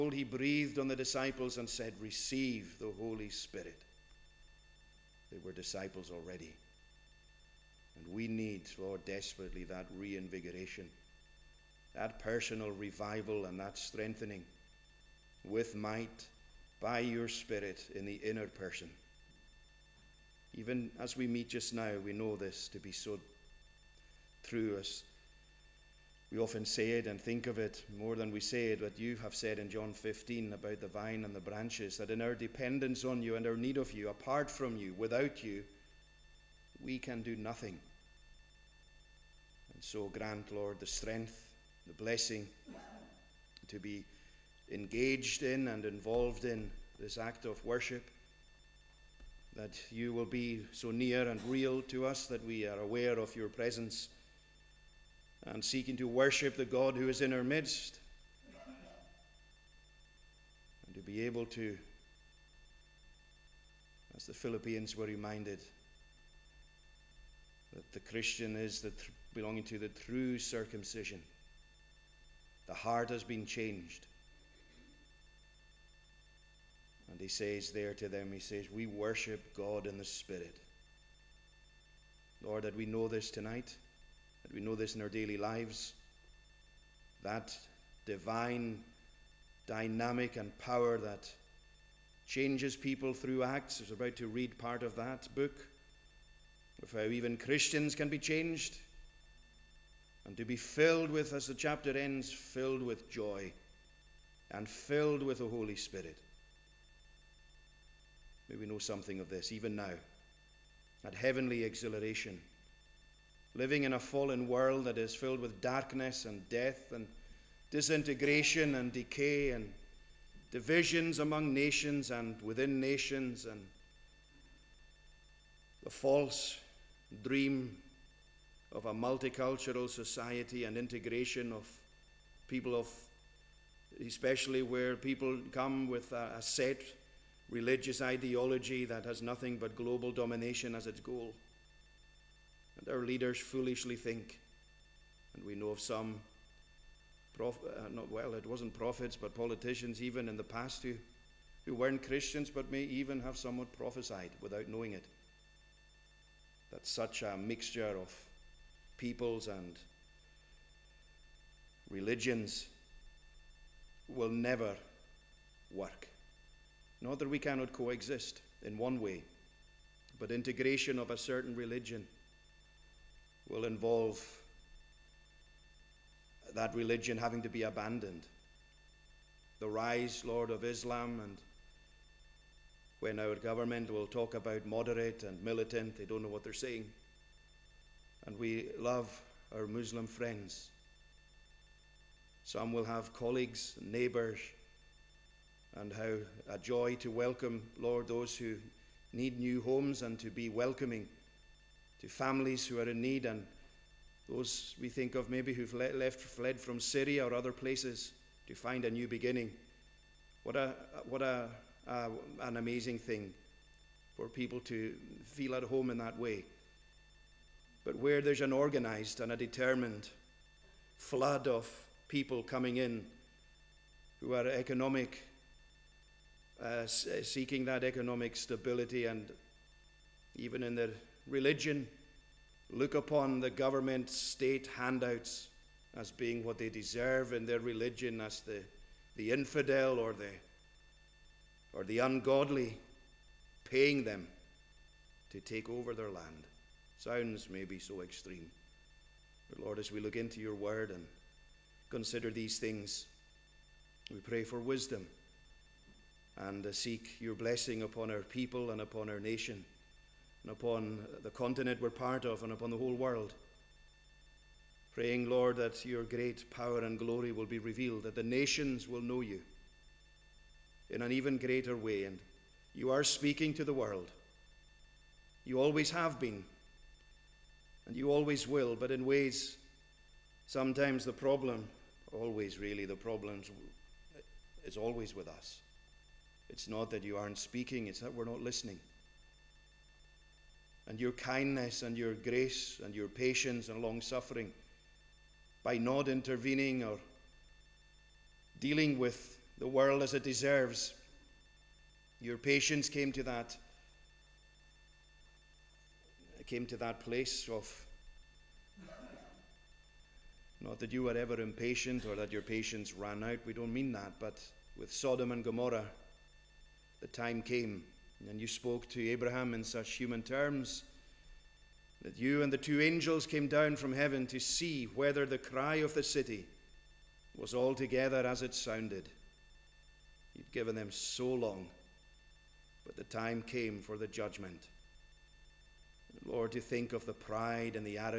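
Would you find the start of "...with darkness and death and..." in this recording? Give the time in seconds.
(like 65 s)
115 s.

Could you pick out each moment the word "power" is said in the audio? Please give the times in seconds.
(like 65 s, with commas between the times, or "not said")
90 s, 266 s.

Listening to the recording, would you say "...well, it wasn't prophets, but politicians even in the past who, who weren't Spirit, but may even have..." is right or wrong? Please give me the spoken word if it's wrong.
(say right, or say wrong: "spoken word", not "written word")
wrong: "Christians", not "Spirit".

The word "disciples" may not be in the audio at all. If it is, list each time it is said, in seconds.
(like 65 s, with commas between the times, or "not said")
0 s, 5 s.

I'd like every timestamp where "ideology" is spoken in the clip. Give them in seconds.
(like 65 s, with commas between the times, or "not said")
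138 s.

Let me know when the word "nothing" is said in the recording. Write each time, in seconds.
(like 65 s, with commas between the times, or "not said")
37 s, 139 s.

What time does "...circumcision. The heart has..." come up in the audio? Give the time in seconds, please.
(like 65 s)
70 s.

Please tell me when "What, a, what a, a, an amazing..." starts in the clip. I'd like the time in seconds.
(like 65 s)
210 s.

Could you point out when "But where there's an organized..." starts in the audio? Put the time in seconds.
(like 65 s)
217 s.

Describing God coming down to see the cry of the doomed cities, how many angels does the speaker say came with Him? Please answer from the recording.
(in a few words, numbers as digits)
2.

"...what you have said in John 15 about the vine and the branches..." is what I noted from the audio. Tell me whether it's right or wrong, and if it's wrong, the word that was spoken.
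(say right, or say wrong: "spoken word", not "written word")
right.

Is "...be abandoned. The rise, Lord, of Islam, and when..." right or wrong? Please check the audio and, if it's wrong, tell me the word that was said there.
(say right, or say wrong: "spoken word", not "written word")
right.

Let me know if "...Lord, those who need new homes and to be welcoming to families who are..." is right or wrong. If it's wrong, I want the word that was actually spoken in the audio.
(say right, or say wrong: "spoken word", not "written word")
right.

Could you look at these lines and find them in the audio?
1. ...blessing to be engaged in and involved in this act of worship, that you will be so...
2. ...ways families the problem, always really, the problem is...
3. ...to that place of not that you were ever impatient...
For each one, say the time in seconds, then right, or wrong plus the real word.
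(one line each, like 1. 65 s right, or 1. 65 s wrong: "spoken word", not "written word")
1. 41 s right
2. 279 s wrong: "sometimes", not "families"
3. 306 s right.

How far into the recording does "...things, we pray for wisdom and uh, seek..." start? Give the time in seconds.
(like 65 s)
252 s.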